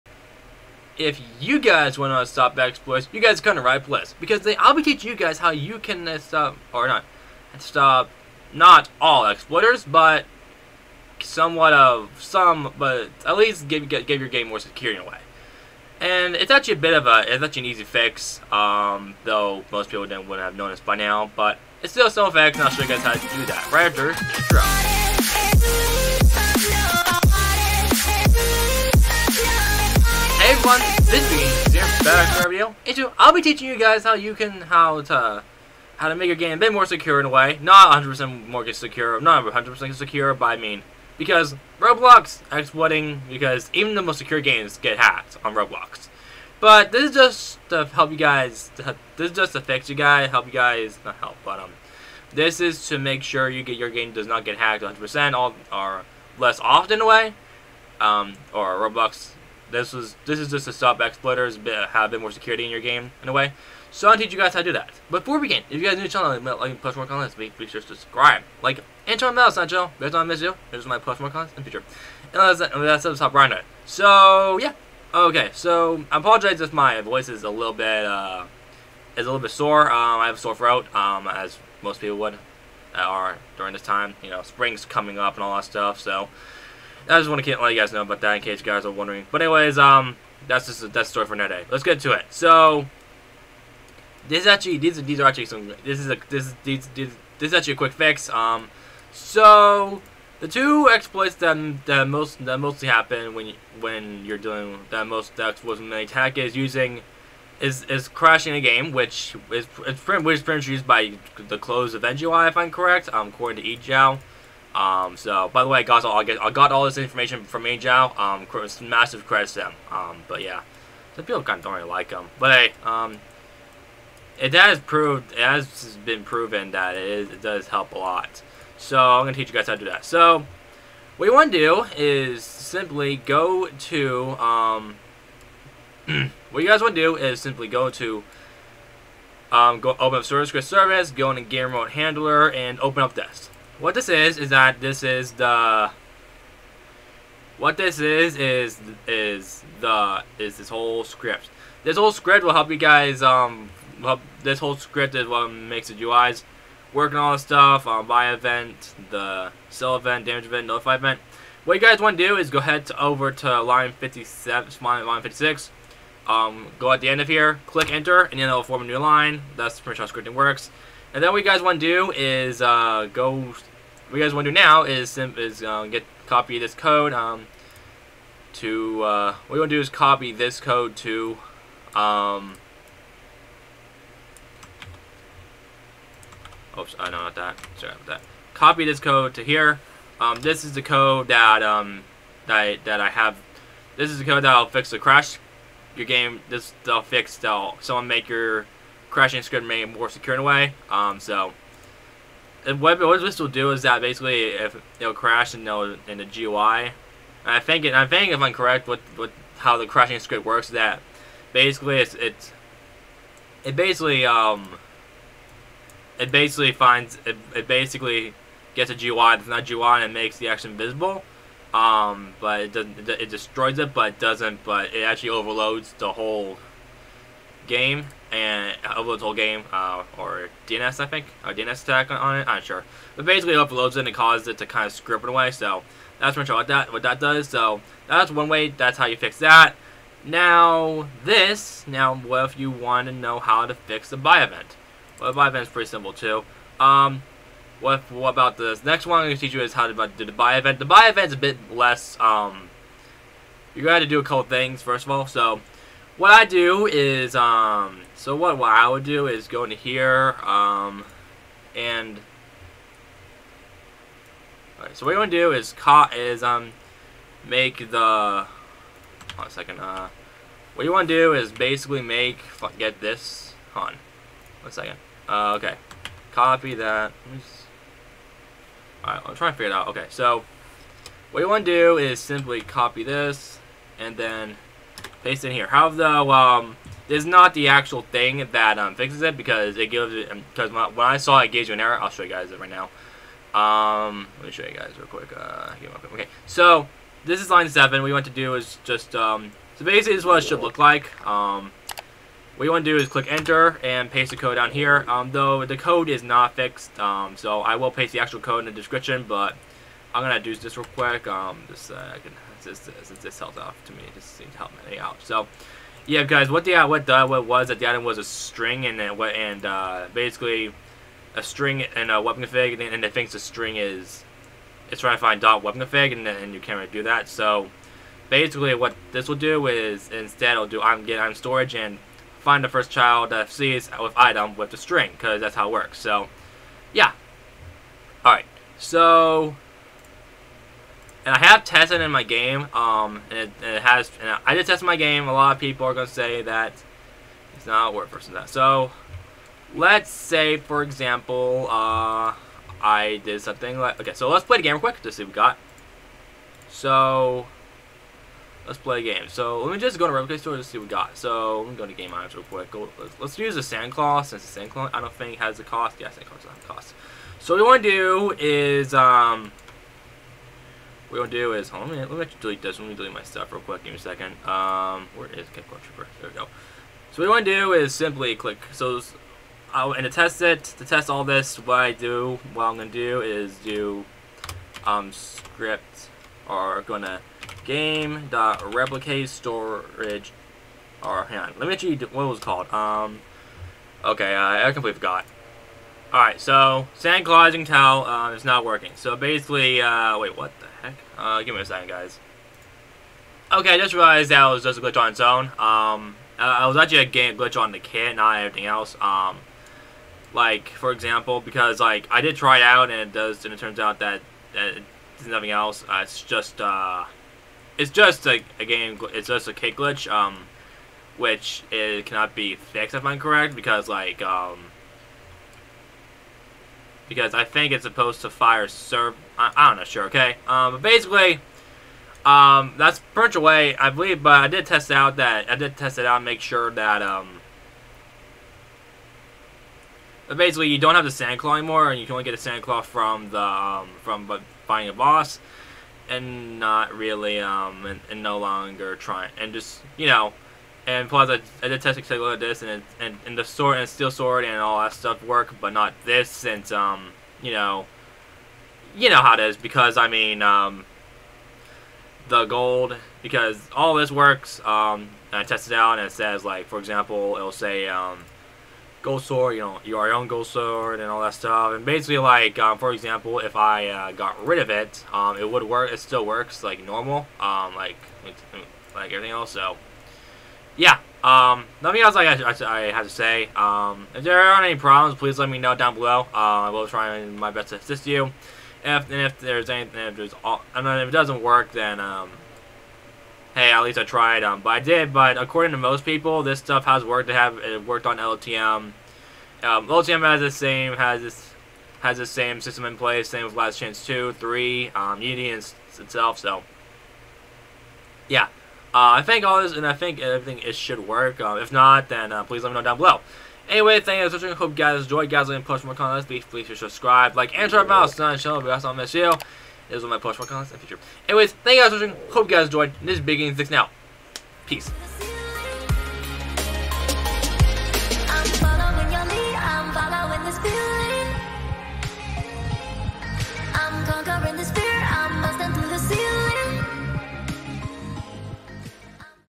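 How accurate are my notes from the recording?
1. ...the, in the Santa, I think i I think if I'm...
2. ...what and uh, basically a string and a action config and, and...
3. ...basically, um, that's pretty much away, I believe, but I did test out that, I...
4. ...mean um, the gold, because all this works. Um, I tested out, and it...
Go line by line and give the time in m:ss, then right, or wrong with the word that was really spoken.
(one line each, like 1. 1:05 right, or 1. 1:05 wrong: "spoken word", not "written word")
1. 3:25 wrong: "GUI", not "Santa"
2. 5:19 wrong: "weapon", not "action"
3. 7:10 right
4. 7:40 right.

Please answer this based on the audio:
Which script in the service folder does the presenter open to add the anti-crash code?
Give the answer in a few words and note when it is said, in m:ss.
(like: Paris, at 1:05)
Game Remote Handler, at 2:21.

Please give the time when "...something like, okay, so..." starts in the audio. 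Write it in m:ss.
5:53.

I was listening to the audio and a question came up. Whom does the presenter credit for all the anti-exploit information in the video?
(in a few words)
Angel.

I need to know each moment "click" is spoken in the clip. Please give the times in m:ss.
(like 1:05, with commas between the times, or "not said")
2:47, 5:03, 6:18.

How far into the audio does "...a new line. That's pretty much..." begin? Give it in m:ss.
2:48.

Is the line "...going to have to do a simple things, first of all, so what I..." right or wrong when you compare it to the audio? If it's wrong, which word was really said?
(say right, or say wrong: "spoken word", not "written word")
wrong: "couple", not "simple".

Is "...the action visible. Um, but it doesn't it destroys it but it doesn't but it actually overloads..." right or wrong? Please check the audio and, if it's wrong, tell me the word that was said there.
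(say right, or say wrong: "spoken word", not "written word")
right.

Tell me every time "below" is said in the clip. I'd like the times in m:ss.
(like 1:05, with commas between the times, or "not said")
8:05, 8:32.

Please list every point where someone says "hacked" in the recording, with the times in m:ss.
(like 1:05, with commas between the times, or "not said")
0:44, 0:54.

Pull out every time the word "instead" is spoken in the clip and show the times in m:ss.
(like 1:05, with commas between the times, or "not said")
5:30.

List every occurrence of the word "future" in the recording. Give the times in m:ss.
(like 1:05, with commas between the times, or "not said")
1:11, 8:40.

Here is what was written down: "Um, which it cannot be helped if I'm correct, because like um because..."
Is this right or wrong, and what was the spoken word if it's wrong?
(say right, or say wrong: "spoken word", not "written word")
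wrong: "fixed", not "helped".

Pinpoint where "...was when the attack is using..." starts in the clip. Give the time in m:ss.
1:45.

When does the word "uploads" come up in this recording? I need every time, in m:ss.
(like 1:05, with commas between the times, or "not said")
3:48, 3:53.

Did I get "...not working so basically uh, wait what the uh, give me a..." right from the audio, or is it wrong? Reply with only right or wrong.
right.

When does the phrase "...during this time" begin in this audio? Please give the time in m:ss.
1:23.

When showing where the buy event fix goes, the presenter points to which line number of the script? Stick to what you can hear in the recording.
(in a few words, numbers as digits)
7.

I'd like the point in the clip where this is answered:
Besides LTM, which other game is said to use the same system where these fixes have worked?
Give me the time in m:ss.
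8:23.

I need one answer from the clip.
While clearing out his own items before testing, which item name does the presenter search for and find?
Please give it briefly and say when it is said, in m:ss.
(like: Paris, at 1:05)
Kickboard Trooper, at 6:15.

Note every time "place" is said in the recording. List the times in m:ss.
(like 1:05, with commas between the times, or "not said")
0:03, 8:22.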